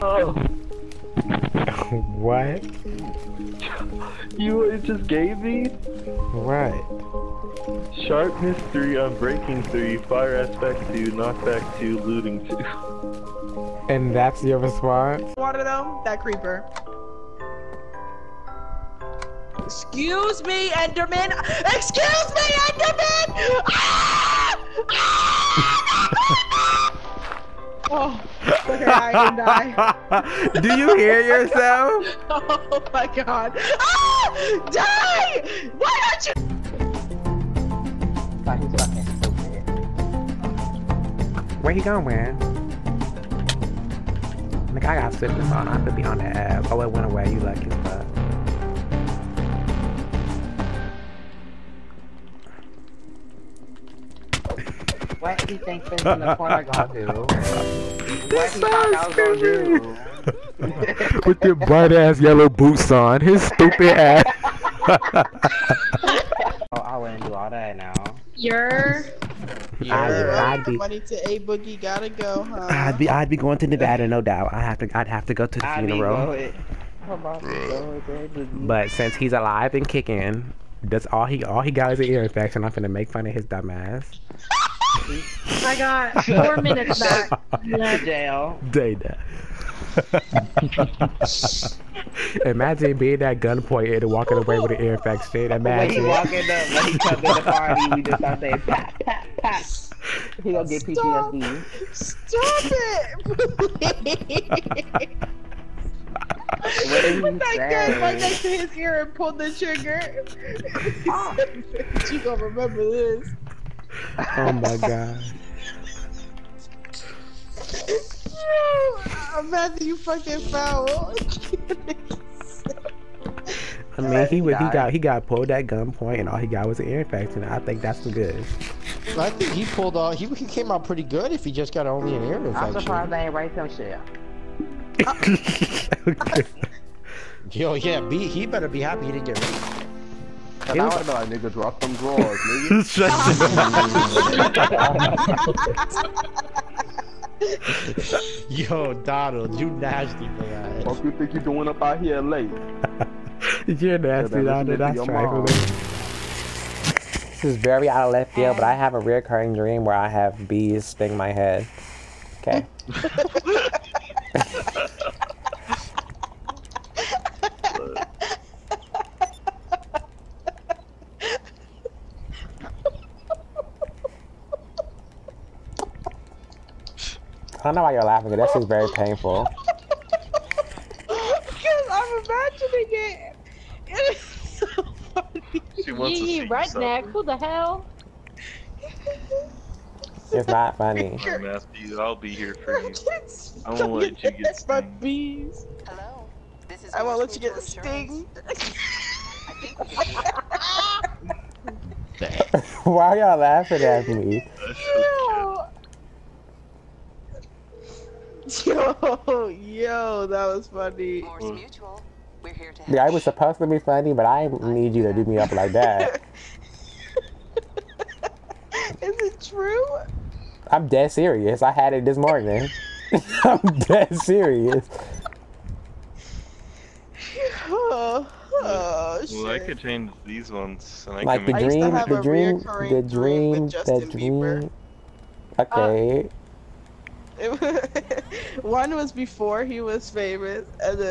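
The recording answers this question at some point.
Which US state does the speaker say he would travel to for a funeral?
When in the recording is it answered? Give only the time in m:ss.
1:13.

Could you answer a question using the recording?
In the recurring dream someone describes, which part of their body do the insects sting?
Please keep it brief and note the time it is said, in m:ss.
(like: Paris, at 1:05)
Head, at 2:41.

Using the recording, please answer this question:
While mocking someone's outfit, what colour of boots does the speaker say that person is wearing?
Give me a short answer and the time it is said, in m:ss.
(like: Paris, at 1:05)
Yellow, at 1:02.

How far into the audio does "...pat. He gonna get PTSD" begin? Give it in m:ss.
1:39.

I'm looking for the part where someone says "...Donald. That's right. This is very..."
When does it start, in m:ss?
2:34.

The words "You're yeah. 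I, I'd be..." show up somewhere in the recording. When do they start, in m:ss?
1:08.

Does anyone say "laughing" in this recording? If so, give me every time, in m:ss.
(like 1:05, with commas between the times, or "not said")
2:58, 3:23.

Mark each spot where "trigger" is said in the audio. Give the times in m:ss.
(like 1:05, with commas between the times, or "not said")
1:49.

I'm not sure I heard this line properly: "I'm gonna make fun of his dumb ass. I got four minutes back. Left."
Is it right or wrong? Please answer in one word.
right.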